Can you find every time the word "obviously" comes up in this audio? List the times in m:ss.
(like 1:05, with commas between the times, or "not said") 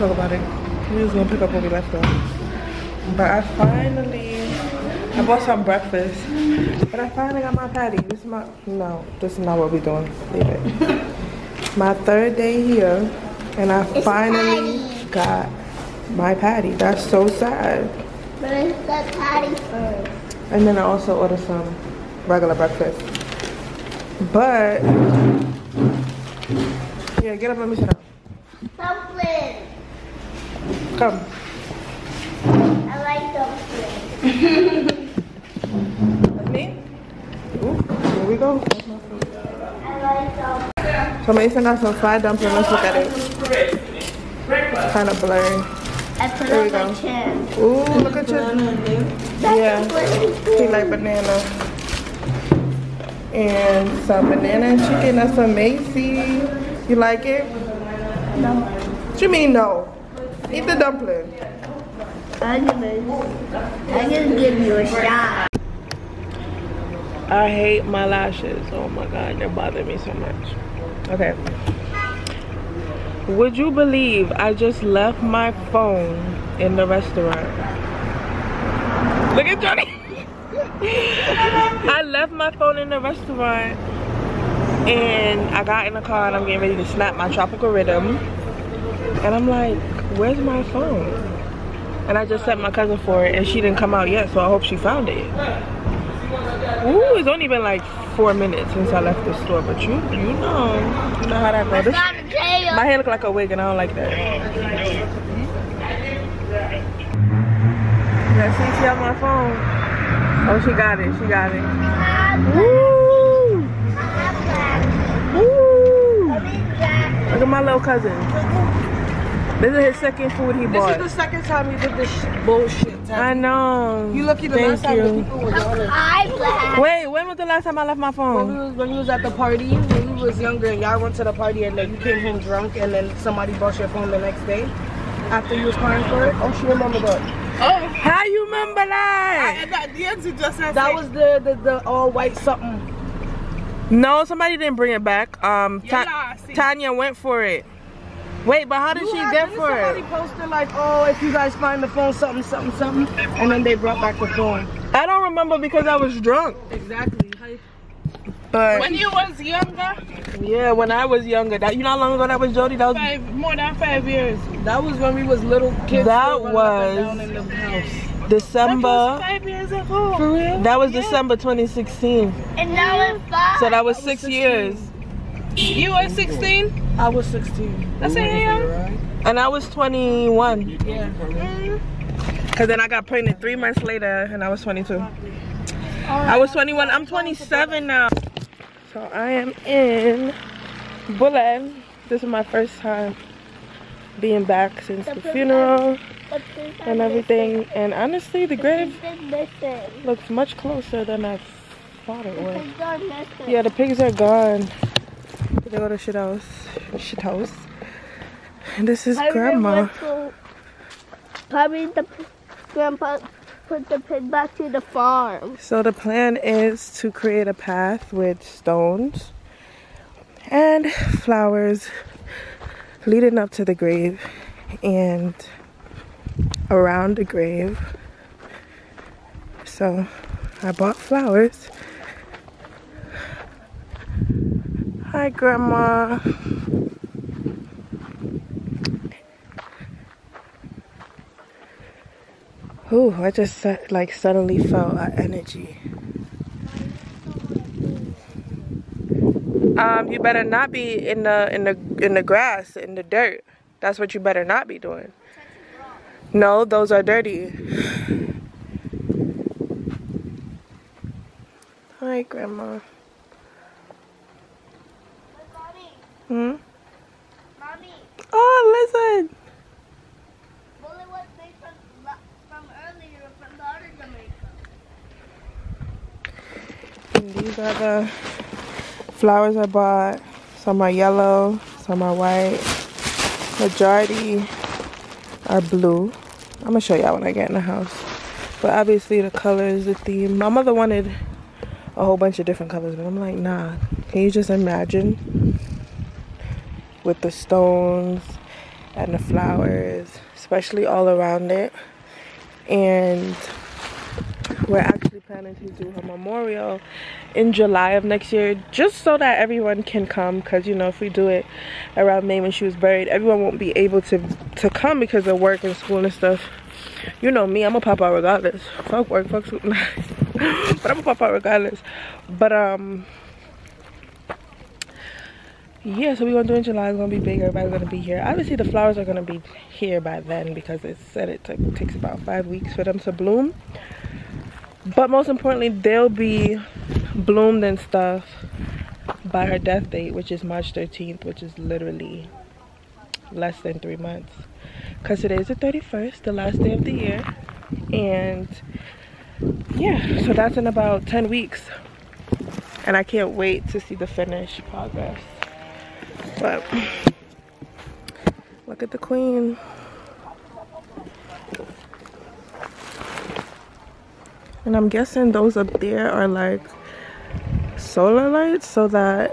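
4:48, 5:28.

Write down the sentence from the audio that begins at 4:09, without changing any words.
Um, you better not be in the in the in the grass in the dirt.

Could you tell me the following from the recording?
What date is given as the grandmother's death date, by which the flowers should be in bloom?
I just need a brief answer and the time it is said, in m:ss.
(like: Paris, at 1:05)
March 13th, at 5:40.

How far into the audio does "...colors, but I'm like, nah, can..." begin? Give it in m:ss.
4:52.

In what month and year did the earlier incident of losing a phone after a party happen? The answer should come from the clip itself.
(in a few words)
December 2016.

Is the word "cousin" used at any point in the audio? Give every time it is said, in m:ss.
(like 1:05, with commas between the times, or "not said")
1:32, 1:57.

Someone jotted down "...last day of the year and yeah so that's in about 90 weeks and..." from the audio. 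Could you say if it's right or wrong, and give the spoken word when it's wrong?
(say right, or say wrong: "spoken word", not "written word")
wrong: "10", not "90".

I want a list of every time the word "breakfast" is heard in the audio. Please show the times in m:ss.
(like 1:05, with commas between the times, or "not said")
0:05, 0:22.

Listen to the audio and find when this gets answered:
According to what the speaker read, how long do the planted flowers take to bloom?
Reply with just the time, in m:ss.
5:32.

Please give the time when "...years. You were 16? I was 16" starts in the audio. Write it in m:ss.
2:54.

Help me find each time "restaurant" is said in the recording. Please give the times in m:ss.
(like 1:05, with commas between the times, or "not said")
1:16, 1:22.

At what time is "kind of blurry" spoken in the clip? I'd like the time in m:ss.
0:44.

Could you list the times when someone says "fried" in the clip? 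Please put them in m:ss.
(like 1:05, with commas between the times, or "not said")
0:41.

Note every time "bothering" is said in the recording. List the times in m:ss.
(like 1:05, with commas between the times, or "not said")
1:09.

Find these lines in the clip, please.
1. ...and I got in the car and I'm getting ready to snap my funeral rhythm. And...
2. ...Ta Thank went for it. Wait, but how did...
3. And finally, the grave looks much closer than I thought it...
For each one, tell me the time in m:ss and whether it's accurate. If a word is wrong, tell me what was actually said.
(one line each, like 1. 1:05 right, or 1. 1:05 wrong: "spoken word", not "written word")
1. 1:24 wrong: "tropical", not "funeral"
2. 2:25 wrong: "Tanya", not "Thank"
3. 3:17 wrong: "honestly", not "finally".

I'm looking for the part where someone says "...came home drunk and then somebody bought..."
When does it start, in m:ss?
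2:11.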